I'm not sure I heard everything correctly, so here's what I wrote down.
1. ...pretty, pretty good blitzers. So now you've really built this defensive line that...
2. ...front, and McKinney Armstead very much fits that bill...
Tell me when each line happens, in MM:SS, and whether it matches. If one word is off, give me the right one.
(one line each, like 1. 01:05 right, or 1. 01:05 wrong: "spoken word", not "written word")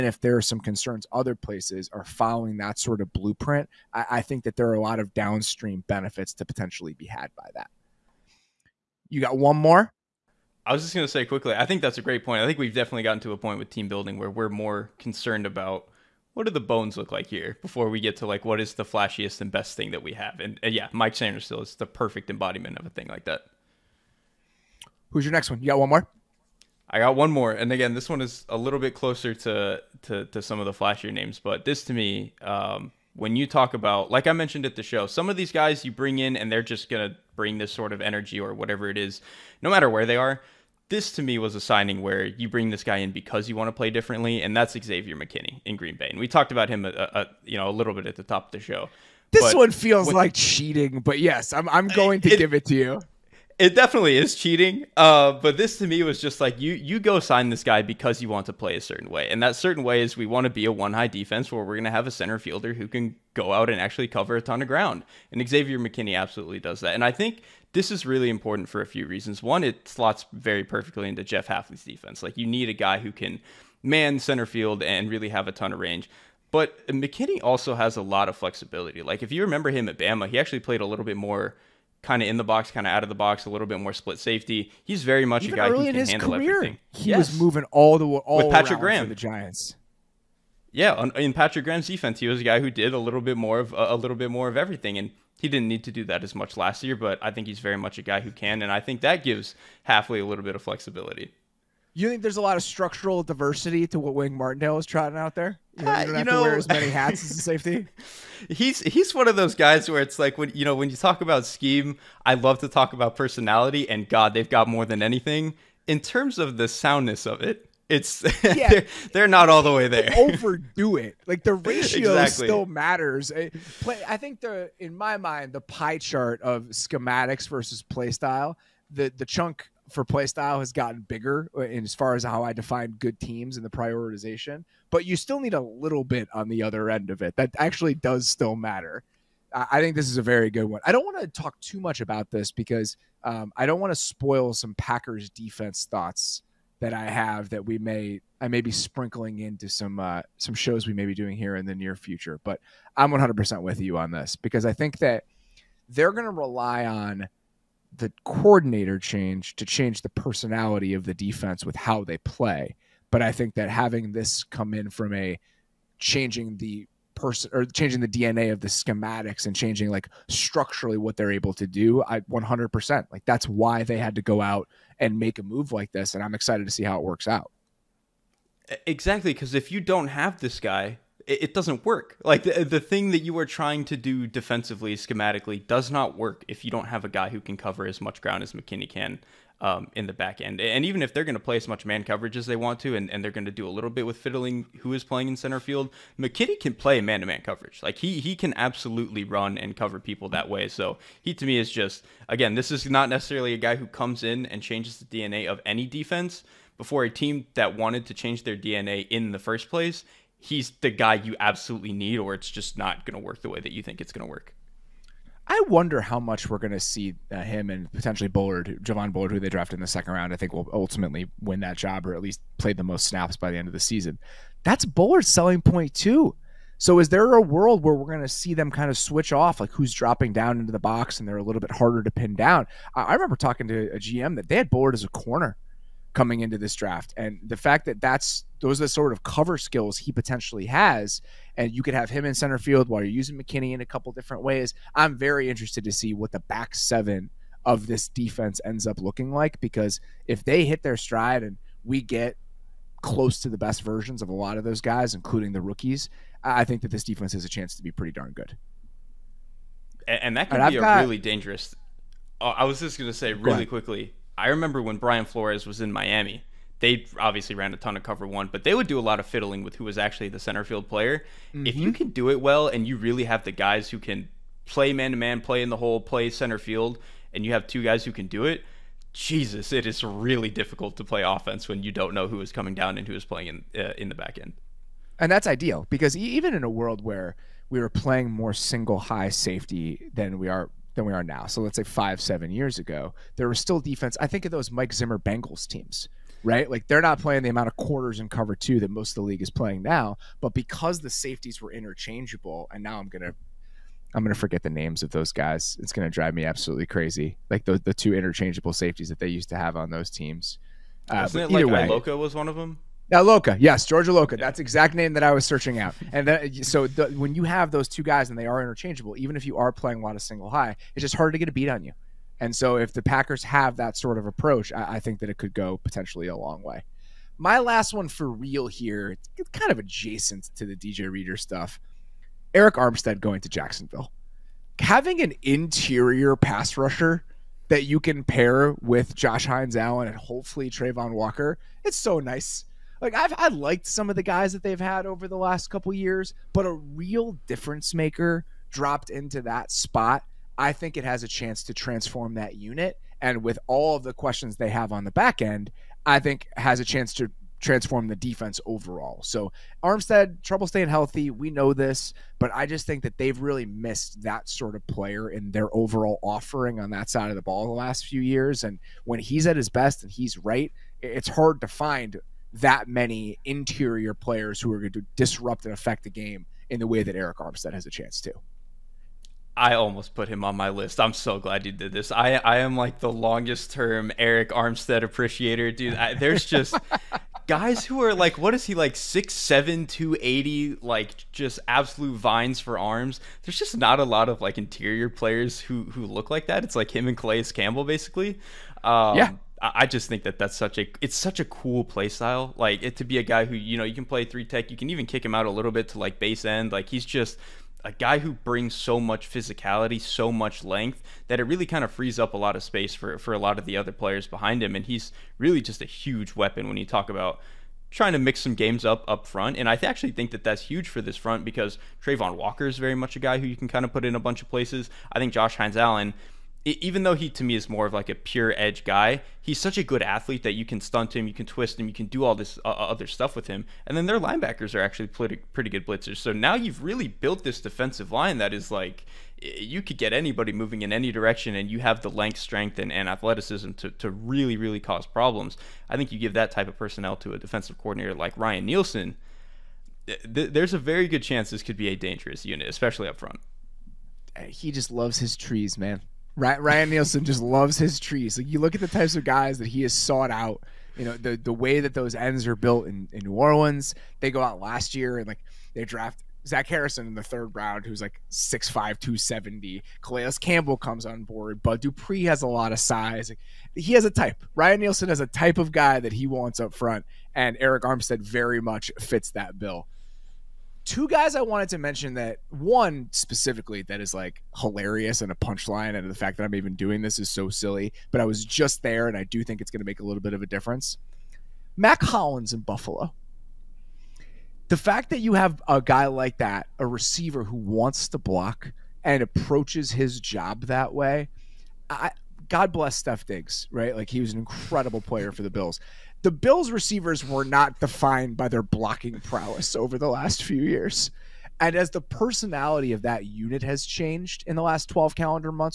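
1. 07:15 right
2. 07:56 wrong: "Arik", not "McKinney".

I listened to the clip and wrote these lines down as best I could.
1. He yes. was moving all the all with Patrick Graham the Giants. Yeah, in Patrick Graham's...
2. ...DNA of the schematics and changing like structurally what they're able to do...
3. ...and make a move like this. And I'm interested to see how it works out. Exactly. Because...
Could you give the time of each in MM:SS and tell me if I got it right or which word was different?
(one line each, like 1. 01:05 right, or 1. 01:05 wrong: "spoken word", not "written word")
1. 01:26 right
2. 02:48 right
3. 02:54 wrong: "excited", not "interested".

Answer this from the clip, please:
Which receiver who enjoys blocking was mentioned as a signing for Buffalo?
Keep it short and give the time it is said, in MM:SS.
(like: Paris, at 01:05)
Mack Hollins, at 08:11.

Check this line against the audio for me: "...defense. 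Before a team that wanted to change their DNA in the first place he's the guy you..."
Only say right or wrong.
right.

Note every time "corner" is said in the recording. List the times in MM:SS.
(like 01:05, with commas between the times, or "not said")
03:55.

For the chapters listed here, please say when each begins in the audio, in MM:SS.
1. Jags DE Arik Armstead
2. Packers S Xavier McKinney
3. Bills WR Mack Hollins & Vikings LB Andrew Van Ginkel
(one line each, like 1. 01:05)
1. 05:26
2. 00:25
3. 07:59.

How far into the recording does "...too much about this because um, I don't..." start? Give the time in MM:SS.
02:21.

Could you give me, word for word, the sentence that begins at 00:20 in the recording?
And, and yeah, Mike Sainristil is the perfect embodiment of a thing like that.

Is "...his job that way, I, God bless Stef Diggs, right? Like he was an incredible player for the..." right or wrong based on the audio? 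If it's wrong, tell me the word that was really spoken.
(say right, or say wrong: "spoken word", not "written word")
right.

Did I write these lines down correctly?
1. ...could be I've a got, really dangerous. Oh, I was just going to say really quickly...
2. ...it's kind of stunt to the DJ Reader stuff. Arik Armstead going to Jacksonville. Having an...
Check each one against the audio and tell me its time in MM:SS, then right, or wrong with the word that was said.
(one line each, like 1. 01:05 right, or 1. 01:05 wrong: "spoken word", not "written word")
1. 04:20 right
2. 05:29 wrong: "adjacent", not "stunt".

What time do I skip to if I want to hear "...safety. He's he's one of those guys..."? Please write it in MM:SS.
01:47.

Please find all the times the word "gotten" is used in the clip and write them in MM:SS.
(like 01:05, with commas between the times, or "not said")
00:13, 02:10.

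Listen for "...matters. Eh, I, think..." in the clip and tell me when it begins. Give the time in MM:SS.
02:02.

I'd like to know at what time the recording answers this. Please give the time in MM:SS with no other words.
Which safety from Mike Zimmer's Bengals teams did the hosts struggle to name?
05:13.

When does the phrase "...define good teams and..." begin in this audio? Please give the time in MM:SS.
02:12.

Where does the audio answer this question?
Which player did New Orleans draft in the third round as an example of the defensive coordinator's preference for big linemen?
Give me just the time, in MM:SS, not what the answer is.
07:46.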